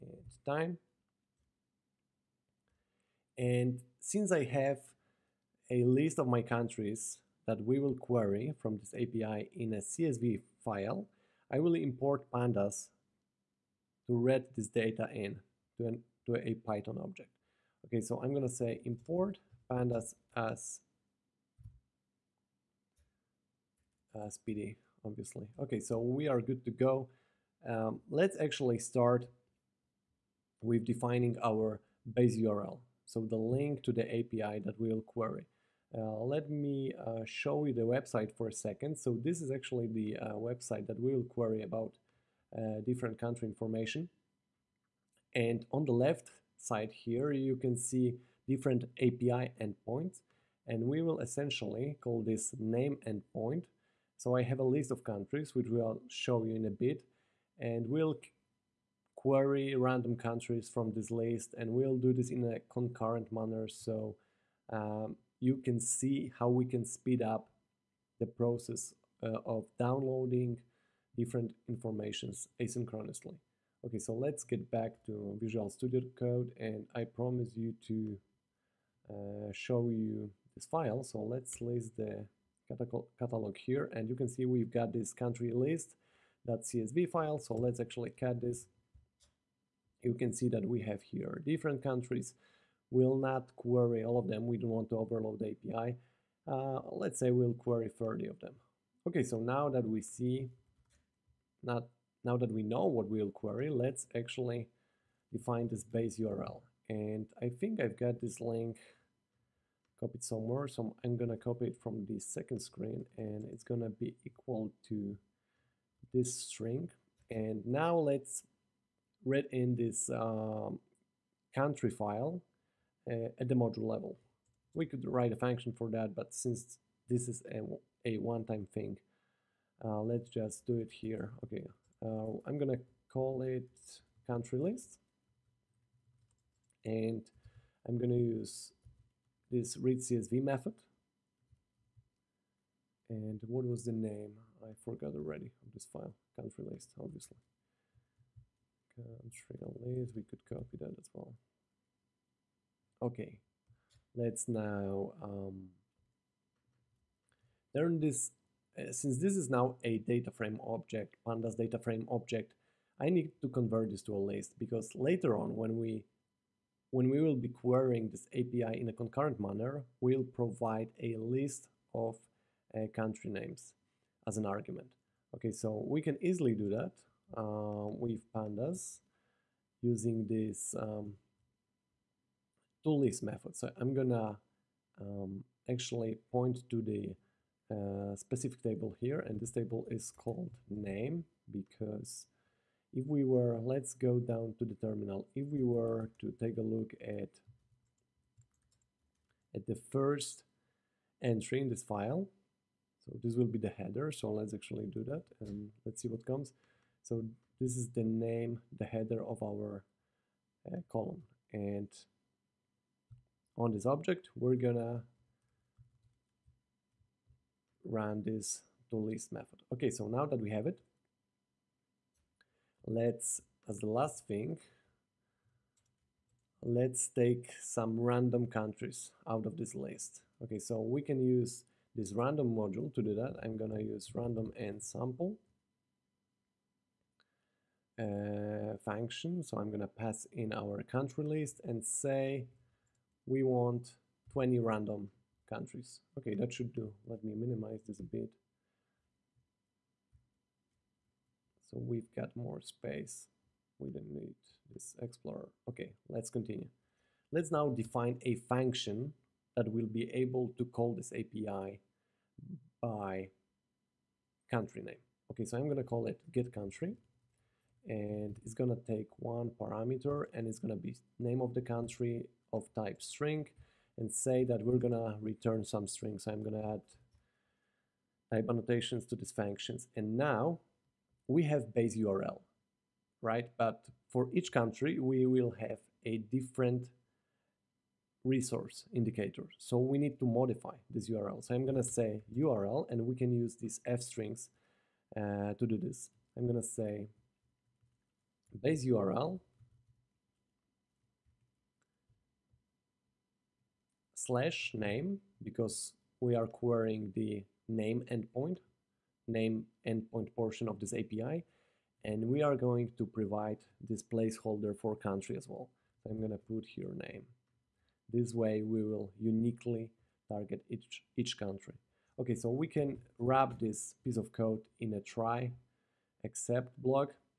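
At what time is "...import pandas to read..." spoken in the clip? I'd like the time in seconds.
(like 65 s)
11 s.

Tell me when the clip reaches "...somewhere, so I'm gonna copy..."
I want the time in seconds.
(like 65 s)
110 s.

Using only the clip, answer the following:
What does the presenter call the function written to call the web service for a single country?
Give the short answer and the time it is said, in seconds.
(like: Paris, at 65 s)
get country, at 266 s.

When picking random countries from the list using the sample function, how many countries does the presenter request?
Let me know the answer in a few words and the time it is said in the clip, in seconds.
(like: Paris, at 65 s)
20, at 244 s.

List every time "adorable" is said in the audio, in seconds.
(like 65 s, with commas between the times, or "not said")
not said.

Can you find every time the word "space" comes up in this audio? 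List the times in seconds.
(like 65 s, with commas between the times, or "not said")
252 s.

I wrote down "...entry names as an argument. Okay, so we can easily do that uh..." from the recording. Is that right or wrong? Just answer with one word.
wrong.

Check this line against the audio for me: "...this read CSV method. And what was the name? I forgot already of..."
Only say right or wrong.
right.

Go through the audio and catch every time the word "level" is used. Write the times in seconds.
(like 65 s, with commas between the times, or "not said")
123 s.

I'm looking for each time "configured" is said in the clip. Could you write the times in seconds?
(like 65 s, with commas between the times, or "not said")
not said.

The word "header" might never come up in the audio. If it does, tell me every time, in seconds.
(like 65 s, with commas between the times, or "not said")
203 s, 208 s.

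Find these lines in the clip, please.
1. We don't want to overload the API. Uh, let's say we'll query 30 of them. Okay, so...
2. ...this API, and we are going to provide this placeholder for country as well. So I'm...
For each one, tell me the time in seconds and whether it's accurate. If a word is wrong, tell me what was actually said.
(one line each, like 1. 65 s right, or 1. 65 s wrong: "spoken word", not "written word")
1. 94 s right
2. 310 s right.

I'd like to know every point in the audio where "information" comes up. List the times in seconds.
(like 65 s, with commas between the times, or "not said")
43 s, 71 s.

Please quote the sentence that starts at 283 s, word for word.
But for each country, we will have a different resource indicator.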